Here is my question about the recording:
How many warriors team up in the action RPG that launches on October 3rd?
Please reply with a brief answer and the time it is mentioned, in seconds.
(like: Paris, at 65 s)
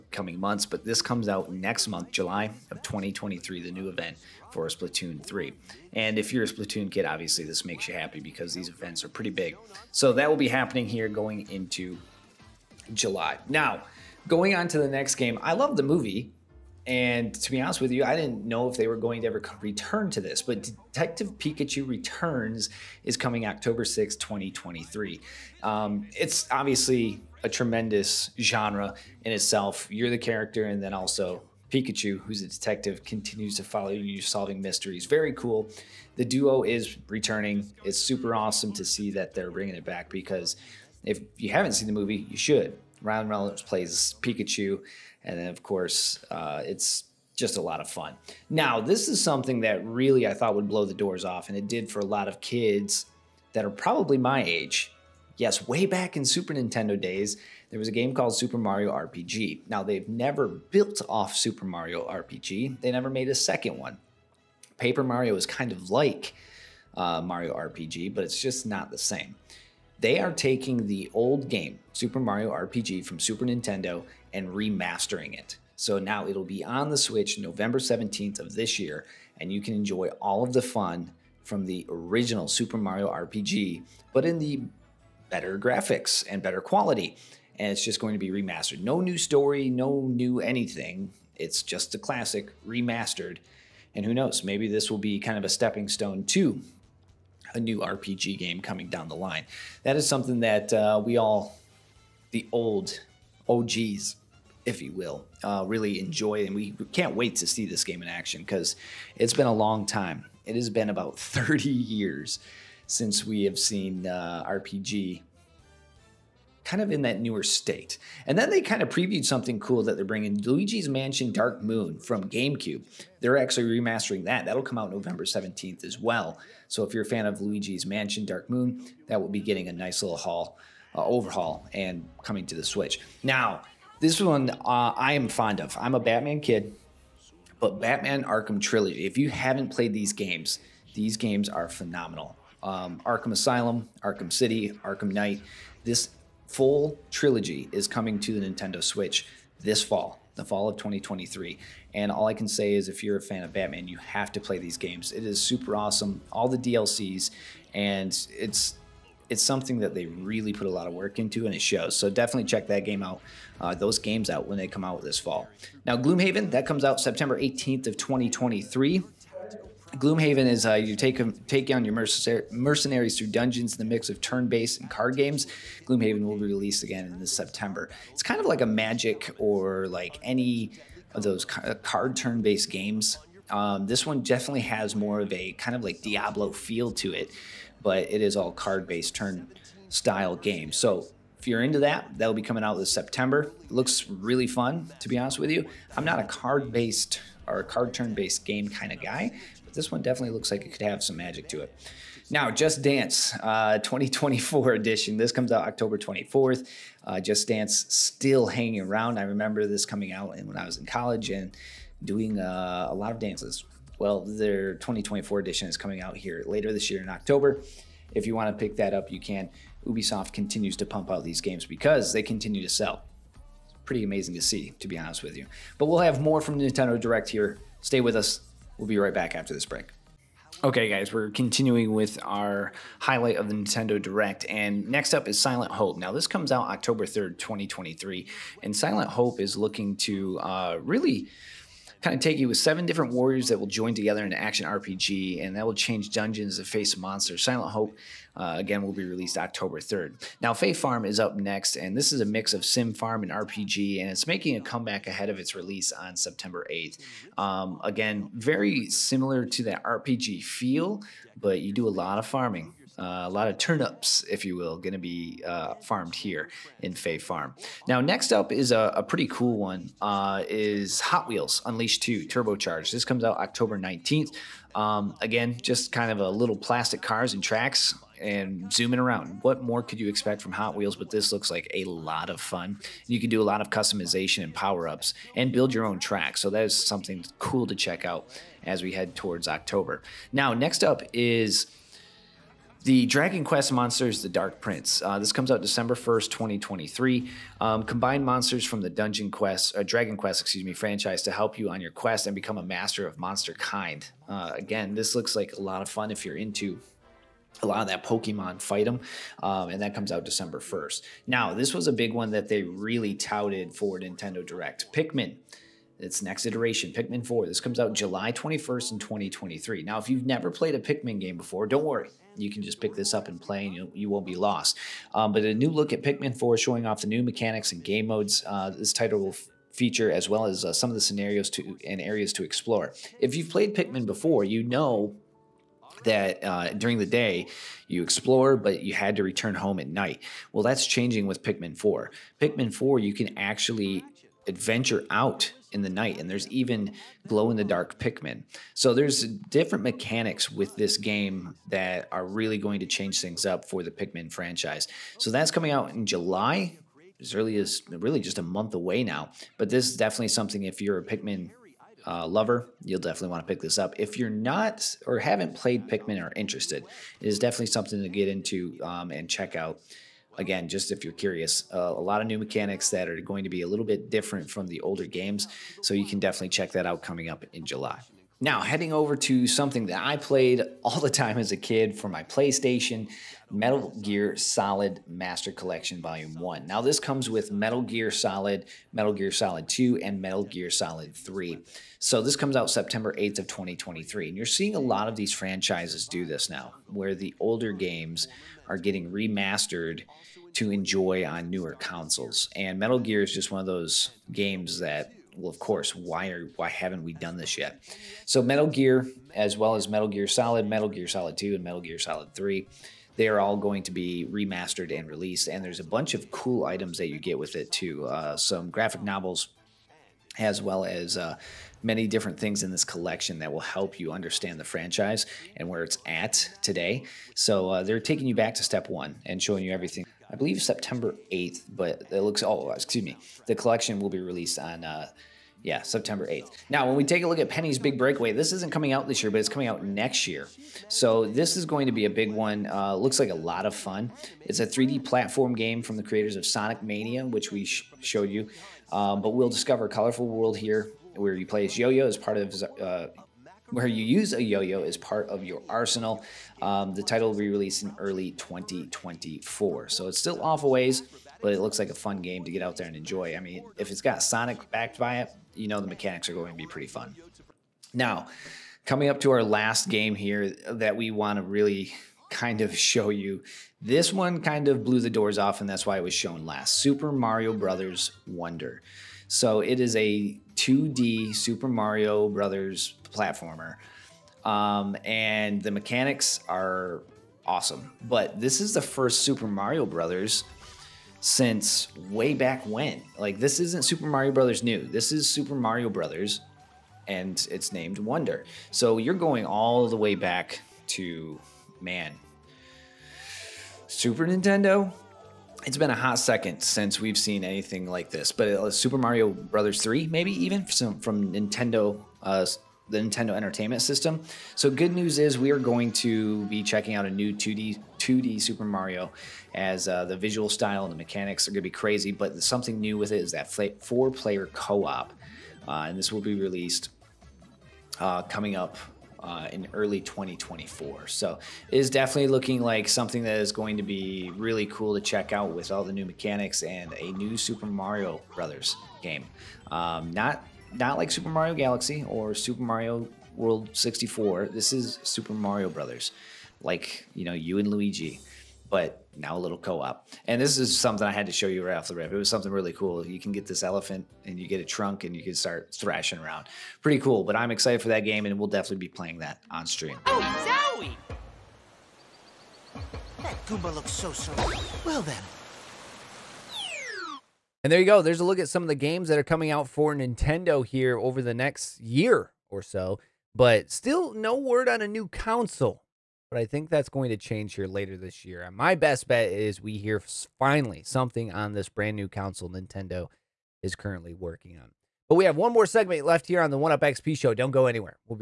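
7, at 242 s.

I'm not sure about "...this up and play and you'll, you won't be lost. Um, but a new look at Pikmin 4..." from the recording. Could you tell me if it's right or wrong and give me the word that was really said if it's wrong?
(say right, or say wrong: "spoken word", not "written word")
right.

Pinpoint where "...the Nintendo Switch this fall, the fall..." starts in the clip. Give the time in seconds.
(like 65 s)
148 s.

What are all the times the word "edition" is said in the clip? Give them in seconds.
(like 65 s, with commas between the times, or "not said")
204 s, 215 s.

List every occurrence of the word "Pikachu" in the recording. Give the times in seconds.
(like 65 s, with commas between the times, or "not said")
21 s, 31 s, 44 s.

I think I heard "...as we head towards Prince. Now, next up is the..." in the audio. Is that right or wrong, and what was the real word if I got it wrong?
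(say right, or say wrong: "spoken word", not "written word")
wrong: "October", not "Prince".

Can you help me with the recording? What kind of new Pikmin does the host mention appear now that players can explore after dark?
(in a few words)
glow in the dark.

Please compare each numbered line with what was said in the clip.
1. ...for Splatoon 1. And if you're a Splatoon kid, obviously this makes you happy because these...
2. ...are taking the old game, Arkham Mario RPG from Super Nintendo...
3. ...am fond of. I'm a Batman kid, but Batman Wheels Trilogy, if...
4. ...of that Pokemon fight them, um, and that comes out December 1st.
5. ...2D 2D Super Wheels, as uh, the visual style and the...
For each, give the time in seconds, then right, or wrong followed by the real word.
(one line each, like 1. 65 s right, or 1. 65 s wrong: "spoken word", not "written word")
1. 4 s wrong: "3", not "1"
2. 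70 s wrong: "Super", not "Arkham"
3. 135 s wrong: "Arkham", not "Wheels"
4. 307 s right
5. 517 s wrong: "Mario", not "Wheels".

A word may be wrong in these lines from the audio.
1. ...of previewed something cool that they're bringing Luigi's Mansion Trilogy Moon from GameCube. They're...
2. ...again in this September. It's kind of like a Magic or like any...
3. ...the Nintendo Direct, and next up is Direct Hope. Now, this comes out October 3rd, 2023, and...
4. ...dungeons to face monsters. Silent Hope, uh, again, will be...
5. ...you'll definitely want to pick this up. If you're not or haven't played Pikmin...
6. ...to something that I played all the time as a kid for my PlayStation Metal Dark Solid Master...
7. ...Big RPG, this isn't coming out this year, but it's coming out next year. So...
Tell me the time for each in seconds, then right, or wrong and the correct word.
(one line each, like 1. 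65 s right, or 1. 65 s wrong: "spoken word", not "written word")
1. 118 s wrong: "Dark", not "Trilogy"
2. 176 s right
3. 233 s wrong: "Silent", not "Direct"
4. 246 s right
5. 362 s right
6. 379 s wrong: "Gear", not "Dark"
7. 437 s wrong: "Breakaway", not "RPG".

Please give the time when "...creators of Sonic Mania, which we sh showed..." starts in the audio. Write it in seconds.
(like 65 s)
446 s.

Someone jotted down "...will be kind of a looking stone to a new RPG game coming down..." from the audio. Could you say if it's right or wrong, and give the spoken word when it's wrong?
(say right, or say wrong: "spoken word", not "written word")
wrong: "stepping", not "looking".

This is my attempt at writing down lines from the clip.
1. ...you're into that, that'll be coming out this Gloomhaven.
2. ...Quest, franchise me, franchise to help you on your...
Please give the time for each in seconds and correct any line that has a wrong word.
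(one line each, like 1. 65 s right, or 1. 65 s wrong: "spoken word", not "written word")
1. 191 s wrong: "September", not "Gloomhaven"
2. 300 s wrong: "excuse", not "franchise".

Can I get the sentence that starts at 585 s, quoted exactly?
But we have one more segment left here on the 1UP XP show.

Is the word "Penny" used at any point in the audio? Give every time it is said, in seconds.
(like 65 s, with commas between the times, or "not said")
437 s.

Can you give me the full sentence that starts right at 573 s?
But still no word on a new console but I think that's going to change here later this year.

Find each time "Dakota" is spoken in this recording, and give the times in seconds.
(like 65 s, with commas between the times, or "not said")
not said.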